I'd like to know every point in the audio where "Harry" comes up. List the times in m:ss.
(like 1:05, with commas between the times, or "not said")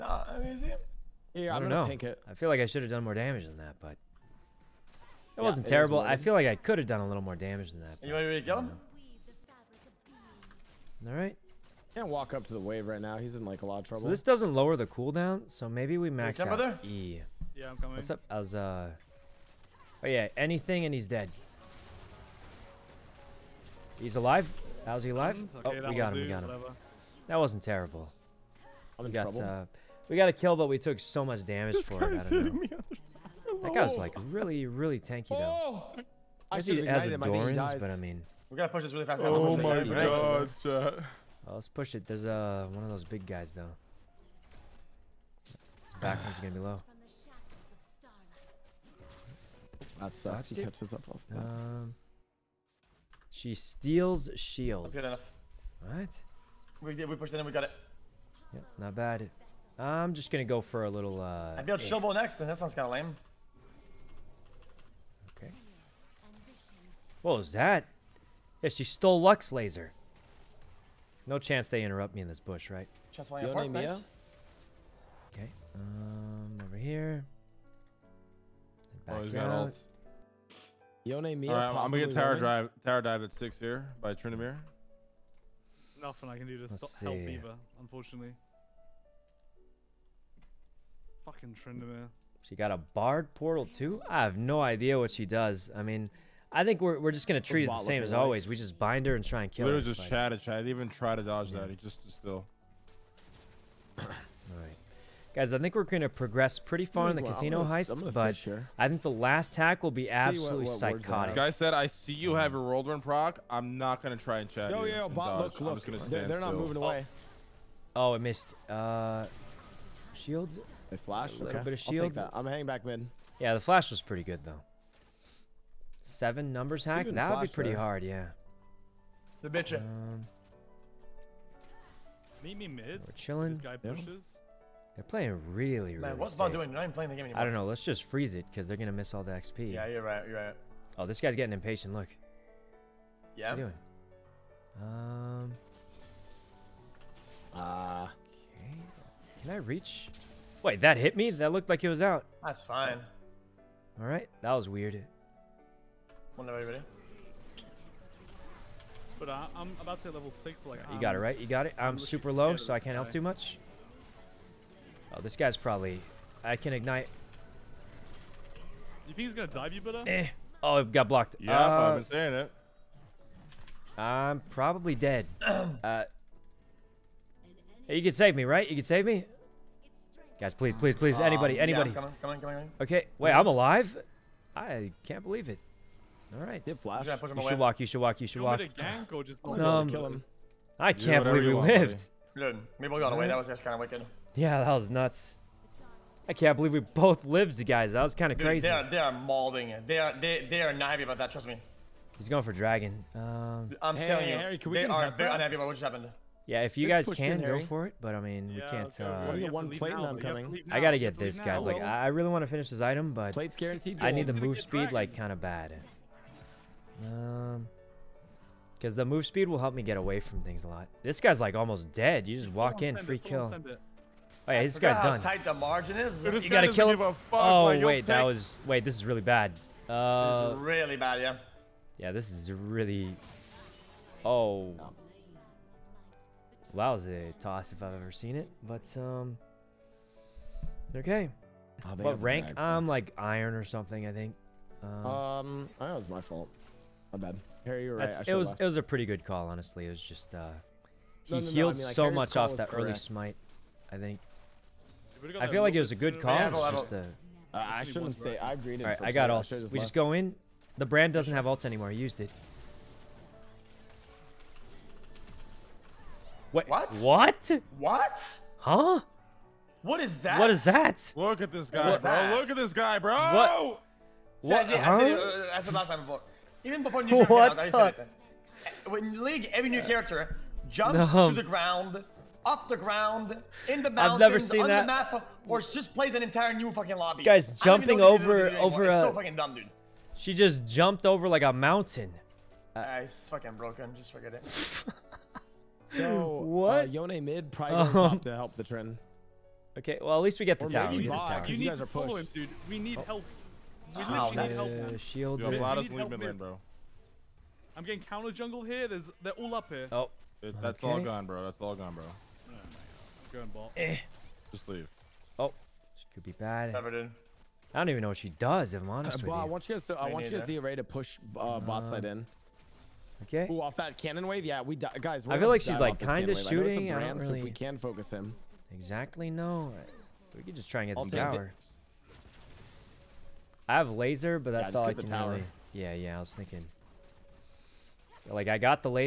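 3:24, 4:07.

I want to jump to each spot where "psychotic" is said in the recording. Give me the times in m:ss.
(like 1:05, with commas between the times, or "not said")
1:50.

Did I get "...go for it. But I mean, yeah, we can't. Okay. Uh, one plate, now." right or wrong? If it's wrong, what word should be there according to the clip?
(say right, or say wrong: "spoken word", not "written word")
right.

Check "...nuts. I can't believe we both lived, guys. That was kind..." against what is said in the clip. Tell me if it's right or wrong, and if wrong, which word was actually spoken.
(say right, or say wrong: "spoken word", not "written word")
right.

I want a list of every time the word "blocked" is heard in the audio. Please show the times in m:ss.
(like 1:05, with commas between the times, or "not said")
2:51.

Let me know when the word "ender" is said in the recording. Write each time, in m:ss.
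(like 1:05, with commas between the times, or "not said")
not said.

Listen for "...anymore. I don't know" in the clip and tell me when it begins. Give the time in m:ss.
2:17.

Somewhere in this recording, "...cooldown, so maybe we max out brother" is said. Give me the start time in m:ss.
0:14.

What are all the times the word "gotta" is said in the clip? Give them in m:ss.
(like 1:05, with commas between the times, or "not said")
0:38, 3:30, 3:46.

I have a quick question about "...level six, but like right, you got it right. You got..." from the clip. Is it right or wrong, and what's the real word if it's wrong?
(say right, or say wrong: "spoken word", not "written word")
right.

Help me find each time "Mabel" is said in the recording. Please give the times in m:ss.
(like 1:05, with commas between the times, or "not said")
3:12.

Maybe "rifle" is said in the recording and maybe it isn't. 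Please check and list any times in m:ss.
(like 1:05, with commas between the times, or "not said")
not said.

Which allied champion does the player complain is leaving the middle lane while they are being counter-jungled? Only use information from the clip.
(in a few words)
Vlad.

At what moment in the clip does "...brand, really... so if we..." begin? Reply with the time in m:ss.
5:26.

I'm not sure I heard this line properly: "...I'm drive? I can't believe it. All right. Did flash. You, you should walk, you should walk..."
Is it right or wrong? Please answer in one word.
wrong.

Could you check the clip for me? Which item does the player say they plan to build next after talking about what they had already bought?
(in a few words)
Shieldbow.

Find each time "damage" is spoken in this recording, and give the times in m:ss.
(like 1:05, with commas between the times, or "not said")
0:03, 0:07, 0:31.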